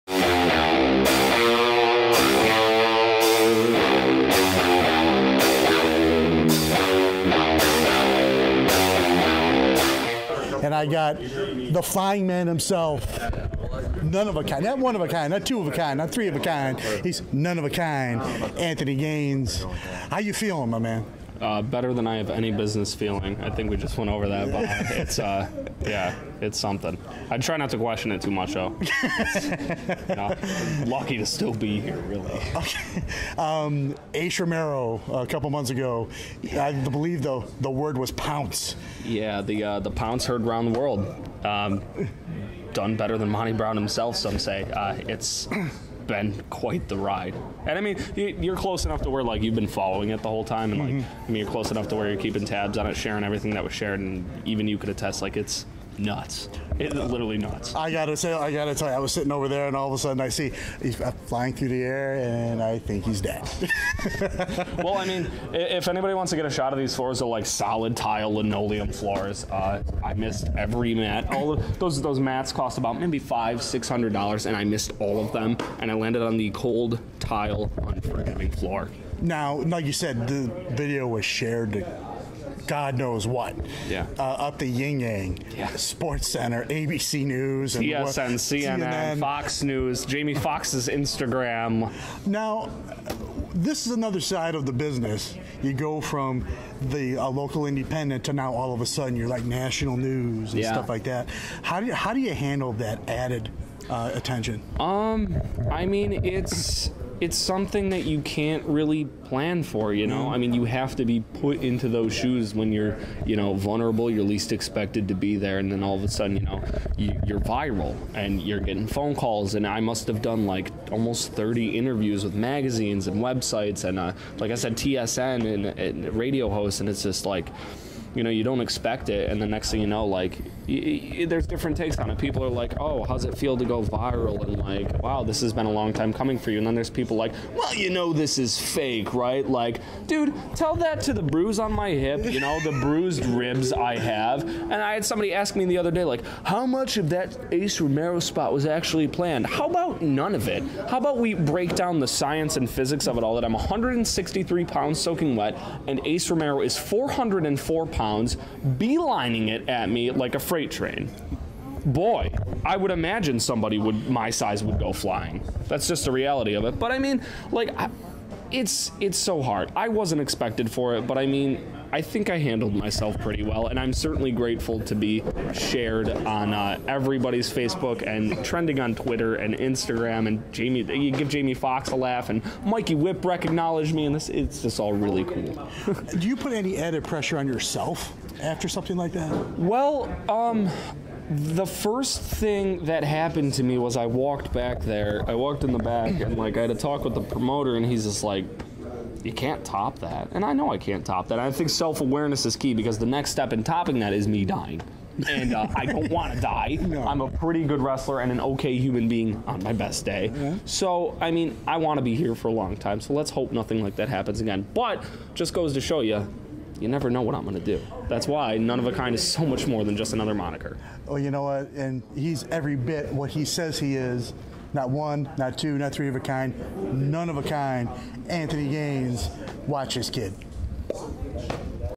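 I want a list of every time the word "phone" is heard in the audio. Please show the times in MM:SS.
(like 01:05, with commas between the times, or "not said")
01:58.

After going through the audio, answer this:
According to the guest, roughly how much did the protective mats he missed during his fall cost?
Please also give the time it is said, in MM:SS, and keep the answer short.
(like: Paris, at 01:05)
$500-600, at 01:13.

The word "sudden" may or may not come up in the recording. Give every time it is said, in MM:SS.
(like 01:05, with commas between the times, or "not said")
00:59, 01:38, 01:56.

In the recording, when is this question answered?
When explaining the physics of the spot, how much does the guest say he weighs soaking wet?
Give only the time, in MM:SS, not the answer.
02:33.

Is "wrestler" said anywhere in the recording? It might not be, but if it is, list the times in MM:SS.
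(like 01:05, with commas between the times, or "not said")
03:27.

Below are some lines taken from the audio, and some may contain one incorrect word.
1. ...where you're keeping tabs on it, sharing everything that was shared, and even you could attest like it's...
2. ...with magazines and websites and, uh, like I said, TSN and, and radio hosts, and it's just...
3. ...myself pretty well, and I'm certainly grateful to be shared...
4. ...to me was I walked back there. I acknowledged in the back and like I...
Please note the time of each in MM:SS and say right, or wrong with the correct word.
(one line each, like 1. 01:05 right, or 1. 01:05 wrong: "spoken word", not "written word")
1. 00:51 right
2. 02:02 right
3. 02:52 right
4. 03:13 wrong: "walked", not "acknowledged".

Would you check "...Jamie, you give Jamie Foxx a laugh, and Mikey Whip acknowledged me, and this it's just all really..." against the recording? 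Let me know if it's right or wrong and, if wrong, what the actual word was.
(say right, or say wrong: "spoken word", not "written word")
right.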